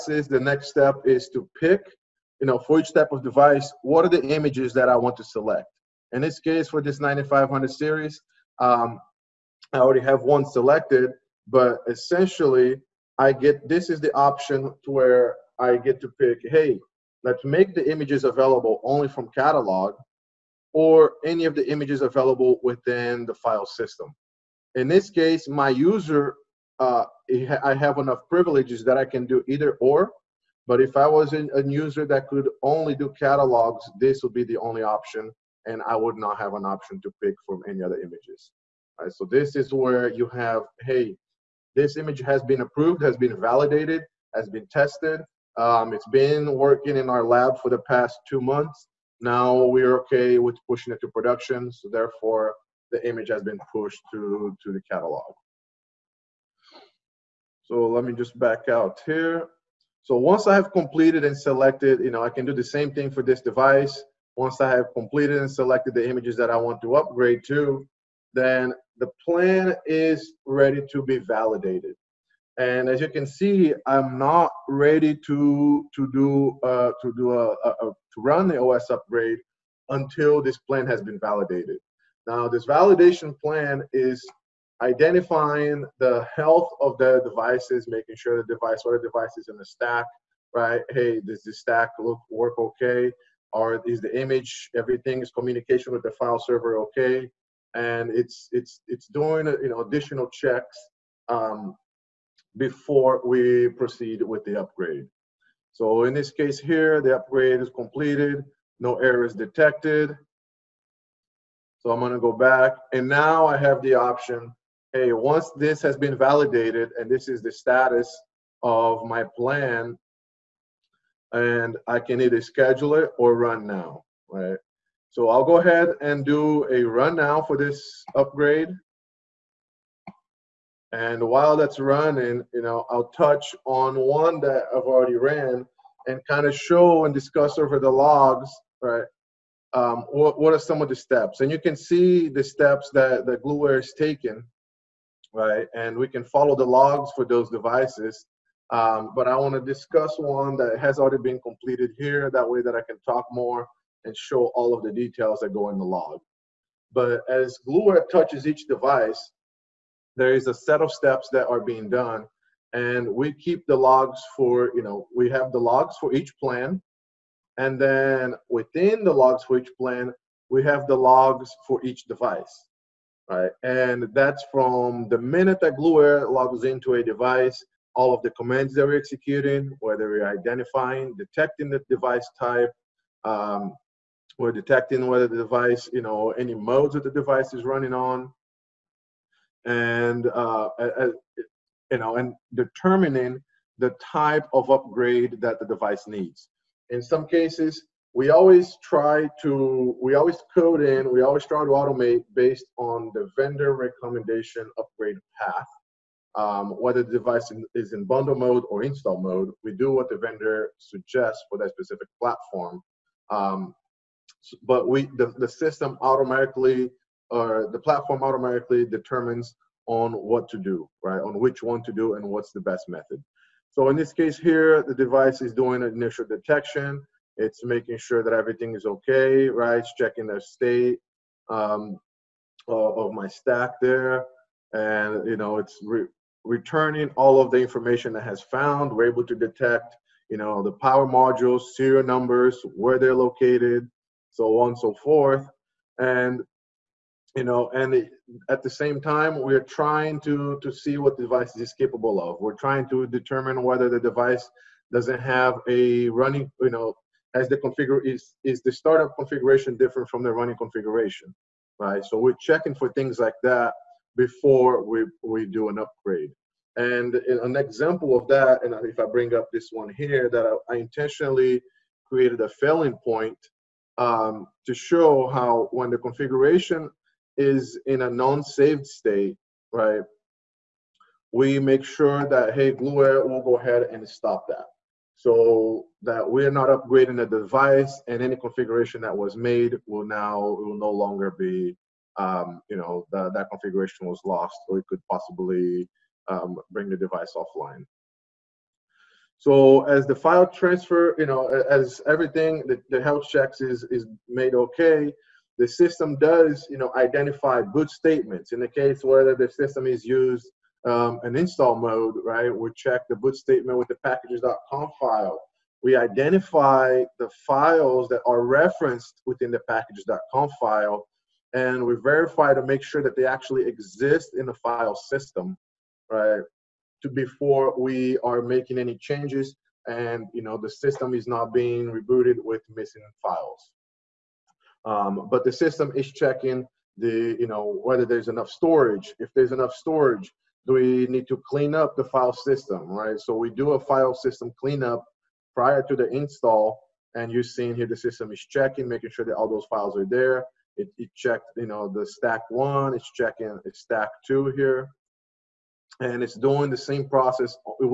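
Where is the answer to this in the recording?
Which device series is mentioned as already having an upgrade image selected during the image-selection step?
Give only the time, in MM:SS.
00:06.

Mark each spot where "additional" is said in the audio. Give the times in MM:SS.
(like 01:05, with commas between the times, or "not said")
01:39.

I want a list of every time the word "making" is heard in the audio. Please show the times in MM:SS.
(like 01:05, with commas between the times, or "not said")
01:27, 03:47, 05:28, 05:48.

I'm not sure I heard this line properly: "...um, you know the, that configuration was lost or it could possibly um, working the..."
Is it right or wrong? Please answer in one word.
wrong.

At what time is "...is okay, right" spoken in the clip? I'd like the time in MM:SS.
03:48.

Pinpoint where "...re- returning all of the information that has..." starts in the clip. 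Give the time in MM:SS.
03:55.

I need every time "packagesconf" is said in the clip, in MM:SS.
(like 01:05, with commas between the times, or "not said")
05:14, 05:19.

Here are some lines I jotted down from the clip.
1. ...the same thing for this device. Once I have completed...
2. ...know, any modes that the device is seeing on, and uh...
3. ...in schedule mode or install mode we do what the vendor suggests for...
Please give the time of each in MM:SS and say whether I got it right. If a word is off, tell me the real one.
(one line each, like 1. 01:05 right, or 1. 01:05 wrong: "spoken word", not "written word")
1. 01:02 right
2. 03:06 wrong: "running", not "seeing"
3. 03:27 wrong: "bundle", not "schedule".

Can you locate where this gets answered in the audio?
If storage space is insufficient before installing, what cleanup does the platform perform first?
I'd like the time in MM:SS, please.
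05:43.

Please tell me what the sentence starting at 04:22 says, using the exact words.
So we're checking for things like that before we we do an upgrade.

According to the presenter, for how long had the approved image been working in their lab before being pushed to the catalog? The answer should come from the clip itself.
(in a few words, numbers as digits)
two months.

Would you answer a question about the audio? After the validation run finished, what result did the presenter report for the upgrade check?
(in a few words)
no errors detected.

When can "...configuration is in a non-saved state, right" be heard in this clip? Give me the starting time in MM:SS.
04:35.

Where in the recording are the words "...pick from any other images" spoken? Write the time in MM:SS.
00:37.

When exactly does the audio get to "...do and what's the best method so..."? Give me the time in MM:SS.
03:41.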